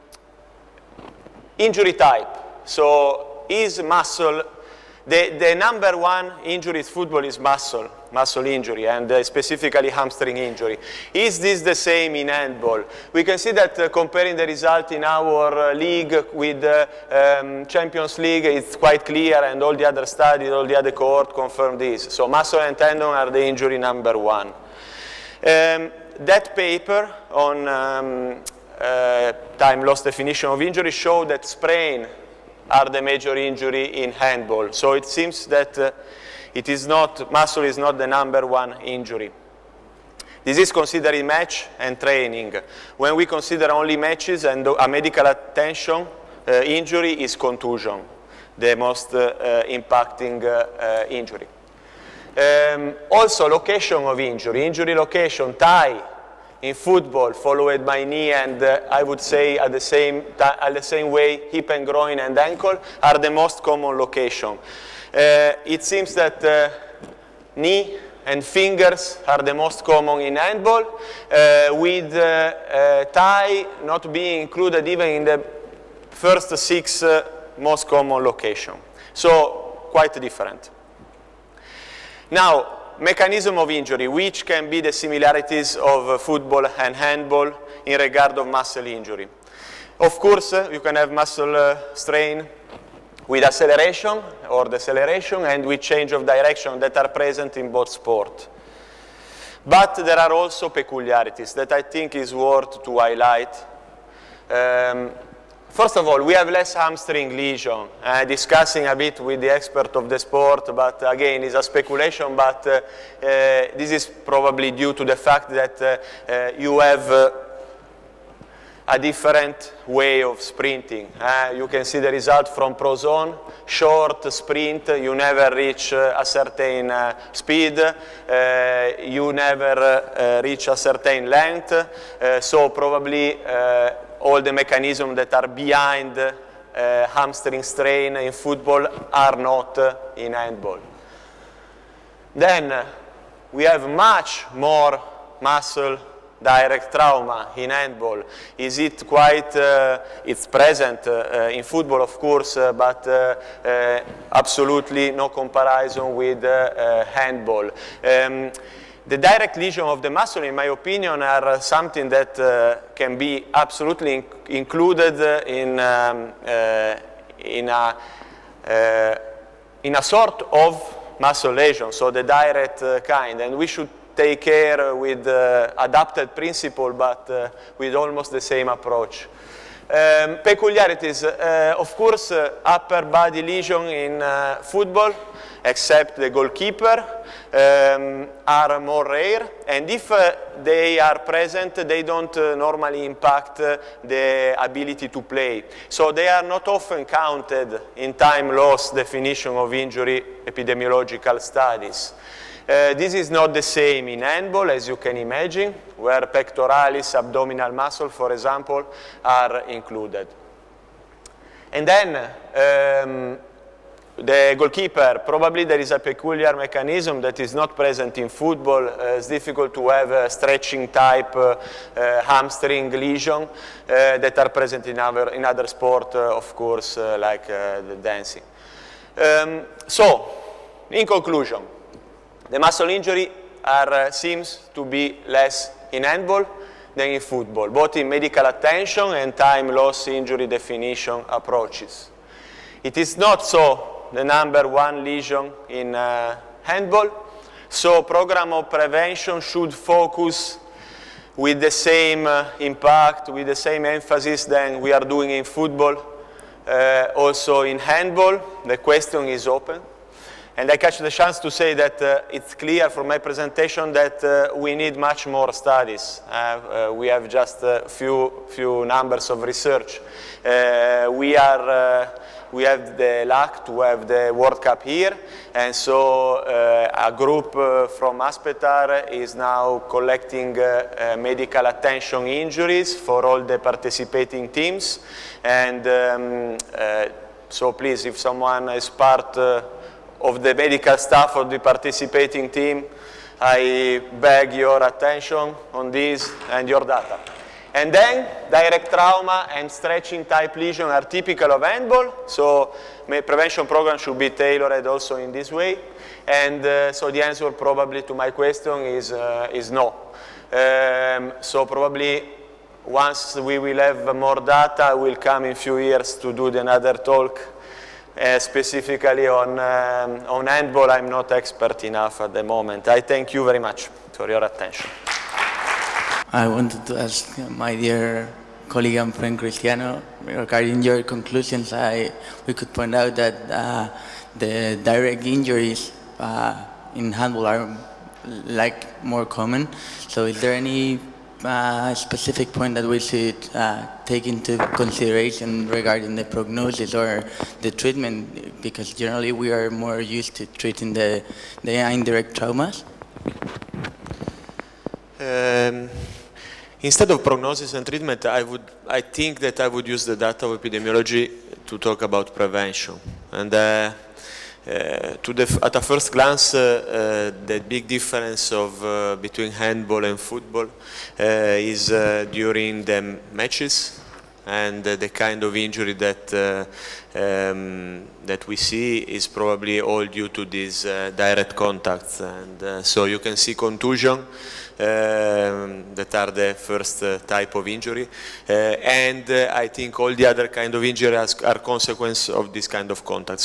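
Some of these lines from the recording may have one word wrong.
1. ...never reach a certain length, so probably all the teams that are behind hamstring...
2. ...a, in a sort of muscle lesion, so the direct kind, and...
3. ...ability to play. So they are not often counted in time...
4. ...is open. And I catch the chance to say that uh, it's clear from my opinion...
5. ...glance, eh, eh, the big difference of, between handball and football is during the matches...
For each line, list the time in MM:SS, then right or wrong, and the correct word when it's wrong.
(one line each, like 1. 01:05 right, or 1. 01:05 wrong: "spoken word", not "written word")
1. 02:09 wrong: "mechanisms", not "teams"
2. 02:47 right
3. 03:14 right
4. 04:19 wrong: "presentation", not "opinion"
5. 06:06 right.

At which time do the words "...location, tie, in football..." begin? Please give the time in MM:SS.
00:54.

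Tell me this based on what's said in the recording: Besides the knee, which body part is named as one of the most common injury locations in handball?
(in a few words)
Fingers.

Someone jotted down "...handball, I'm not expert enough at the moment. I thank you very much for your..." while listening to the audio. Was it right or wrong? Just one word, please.
right.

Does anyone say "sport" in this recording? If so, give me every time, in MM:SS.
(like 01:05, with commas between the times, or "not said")
01:37, 01:50, 03:45.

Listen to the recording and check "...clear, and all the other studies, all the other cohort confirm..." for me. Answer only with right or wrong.
right.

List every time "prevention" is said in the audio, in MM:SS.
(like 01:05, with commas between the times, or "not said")
04:08, 05:03, 06:02.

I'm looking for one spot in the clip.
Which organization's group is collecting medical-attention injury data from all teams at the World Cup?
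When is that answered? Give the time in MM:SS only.
04:38.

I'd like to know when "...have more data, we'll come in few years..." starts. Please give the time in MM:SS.
05:13.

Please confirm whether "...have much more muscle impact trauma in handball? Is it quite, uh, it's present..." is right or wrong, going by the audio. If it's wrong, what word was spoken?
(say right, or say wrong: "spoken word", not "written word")
wrong: "direct", not "impact".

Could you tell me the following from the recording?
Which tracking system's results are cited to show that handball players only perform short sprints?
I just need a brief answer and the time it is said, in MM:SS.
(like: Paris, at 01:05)
Prozone, at 02:02.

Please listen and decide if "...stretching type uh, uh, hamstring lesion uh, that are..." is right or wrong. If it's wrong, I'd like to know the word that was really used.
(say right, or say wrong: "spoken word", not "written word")
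right.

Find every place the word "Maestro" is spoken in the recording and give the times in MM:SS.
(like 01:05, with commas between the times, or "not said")
not said.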